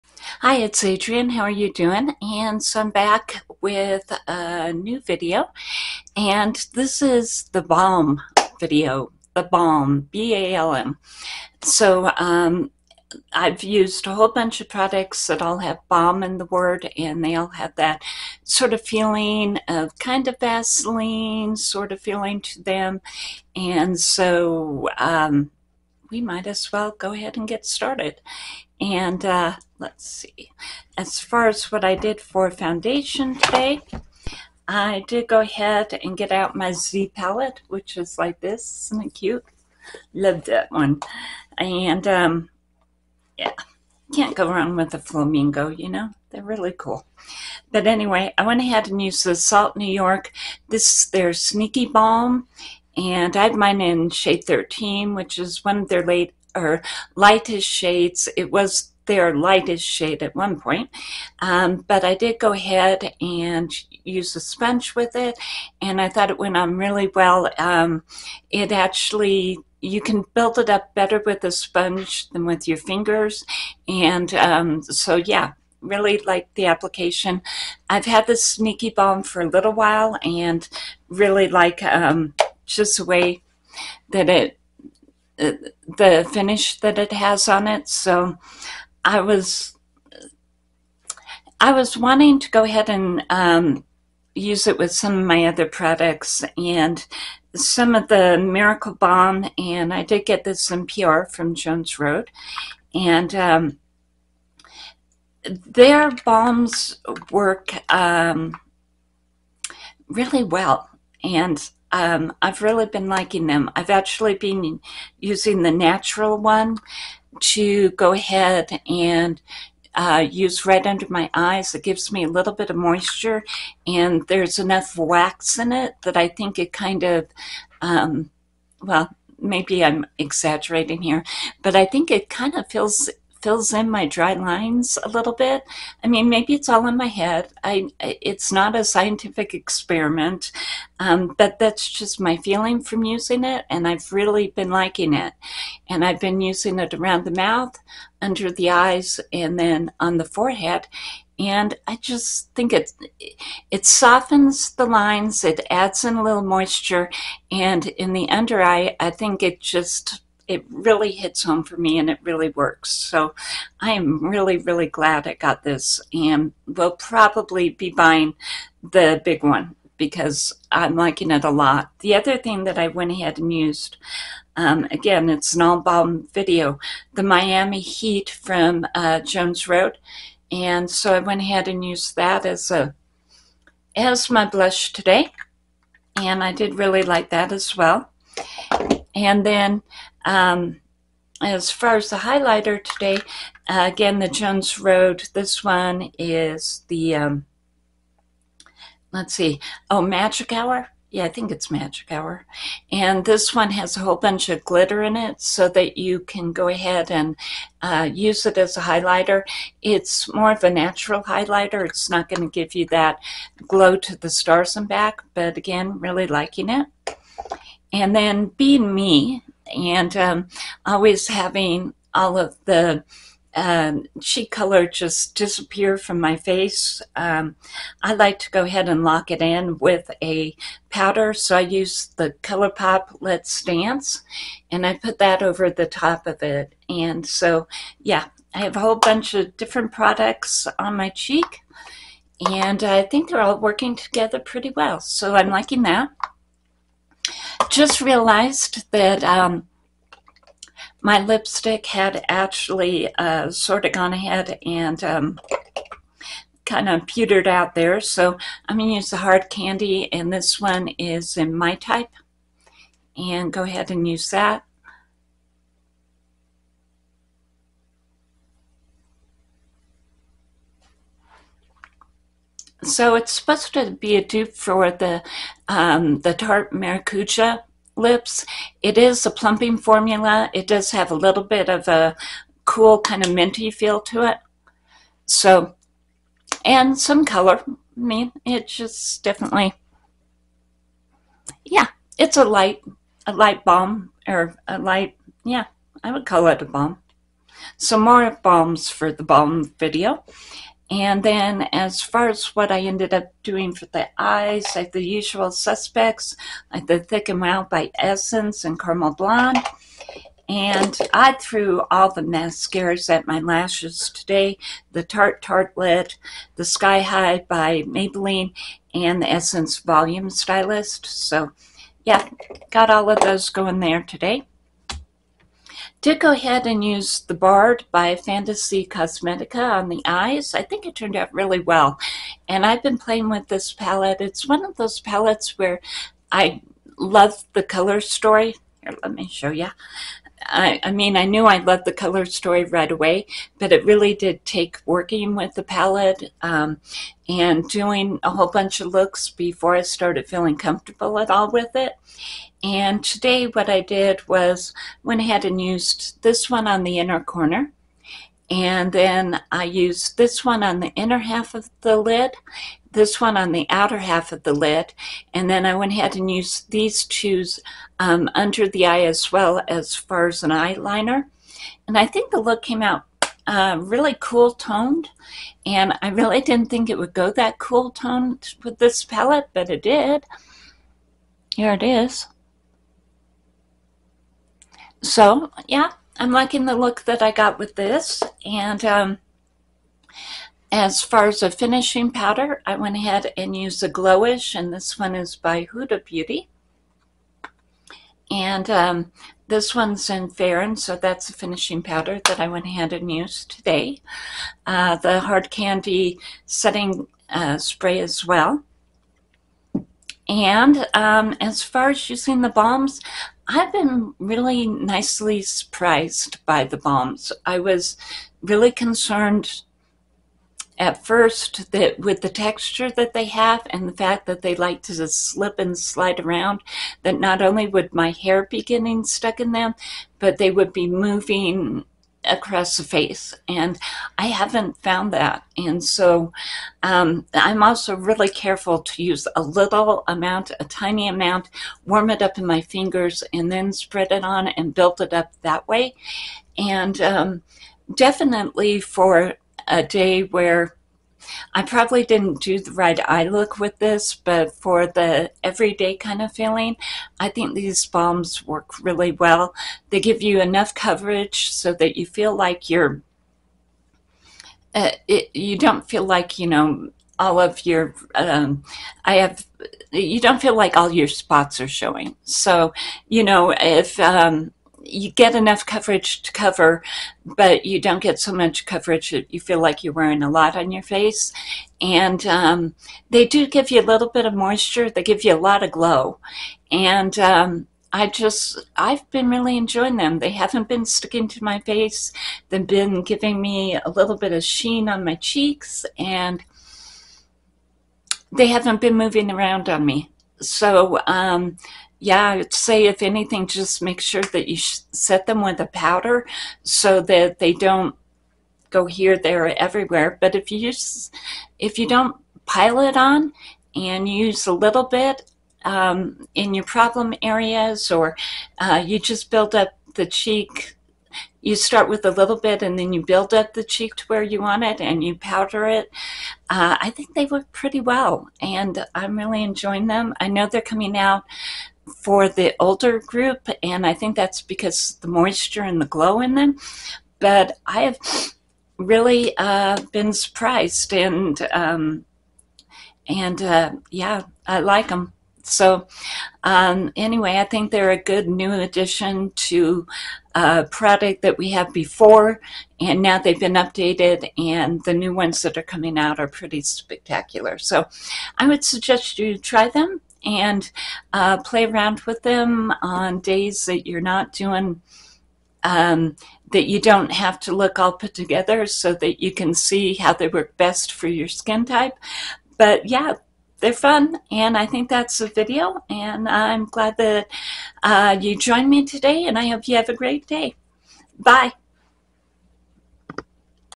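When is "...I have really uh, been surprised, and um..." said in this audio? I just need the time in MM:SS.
08:57.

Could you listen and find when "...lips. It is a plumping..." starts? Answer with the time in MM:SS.
04:37.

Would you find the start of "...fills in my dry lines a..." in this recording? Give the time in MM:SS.
02:13.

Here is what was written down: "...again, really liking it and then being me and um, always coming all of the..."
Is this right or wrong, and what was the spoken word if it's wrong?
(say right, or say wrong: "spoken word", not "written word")
wrong: "having", not "coming".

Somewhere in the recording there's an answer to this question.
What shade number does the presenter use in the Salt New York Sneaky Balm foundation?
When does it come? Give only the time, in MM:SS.
00:54.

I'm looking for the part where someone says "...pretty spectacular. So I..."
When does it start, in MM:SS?
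09:16.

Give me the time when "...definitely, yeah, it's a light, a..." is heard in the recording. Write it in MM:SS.
04:49.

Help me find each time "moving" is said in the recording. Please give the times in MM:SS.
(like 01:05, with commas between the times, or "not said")
07:10, 08:18.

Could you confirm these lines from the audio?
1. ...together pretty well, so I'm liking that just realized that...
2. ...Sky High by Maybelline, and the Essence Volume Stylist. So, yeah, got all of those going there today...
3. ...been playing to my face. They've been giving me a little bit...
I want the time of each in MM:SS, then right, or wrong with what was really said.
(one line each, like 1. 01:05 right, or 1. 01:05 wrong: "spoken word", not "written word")
1. 04:03 right
2. 05:16 right
3. 08:10 wrong: "sticking", not "playing".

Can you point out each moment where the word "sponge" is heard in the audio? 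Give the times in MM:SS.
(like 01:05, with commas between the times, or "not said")
01:04, 01:11.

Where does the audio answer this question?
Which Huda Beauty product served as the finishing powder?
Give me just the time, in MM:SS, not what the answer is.
06:33.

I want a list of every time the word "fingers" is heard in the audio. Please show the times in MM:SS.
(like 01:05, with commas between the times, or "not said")
01:12, 07:22.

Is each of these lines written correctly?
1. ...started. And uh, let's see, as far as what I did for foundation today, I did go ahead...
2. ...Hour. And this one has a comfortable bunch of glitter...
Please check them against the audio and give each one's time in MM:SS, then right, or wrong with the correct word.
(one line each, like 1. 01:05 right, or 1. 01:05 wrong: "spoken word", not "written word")
1. 00:27 right
2. 03:22 wrong: "whole", not "comfortable".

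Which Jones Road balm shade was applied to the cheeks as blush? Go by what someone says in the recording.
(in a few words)
Miami Heat.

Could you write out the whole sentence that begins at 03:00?
And so I went ahead and used that as a as my blush today.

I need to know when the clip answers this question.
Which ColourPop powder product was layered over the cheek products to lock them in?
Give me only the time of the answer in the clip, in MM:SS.
03:53.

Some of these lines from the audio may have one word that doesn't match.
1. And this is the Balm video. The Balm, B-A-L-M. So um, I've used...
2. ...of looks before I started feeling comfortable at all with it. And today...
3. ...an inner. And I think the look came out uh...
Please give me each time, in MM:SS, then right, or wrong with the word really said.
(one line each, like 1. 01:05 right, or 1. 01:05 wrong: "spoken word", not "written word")
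1. 00:06 right
2. 05:48 right
3. 06:10 wrong: "eyeliner", not "inner".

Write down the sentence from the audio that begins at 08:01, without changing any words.
And um, they do give you a little bit of moisture.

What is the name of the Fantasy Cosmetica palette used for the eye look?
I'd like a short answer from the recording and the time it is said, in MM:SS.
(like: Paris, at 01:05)
The Bard, at 05:27.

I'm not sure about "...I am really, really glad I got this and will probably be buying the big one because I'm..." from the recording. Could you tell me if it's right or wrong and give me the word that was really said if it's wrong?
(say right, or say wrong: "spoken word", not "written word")
right.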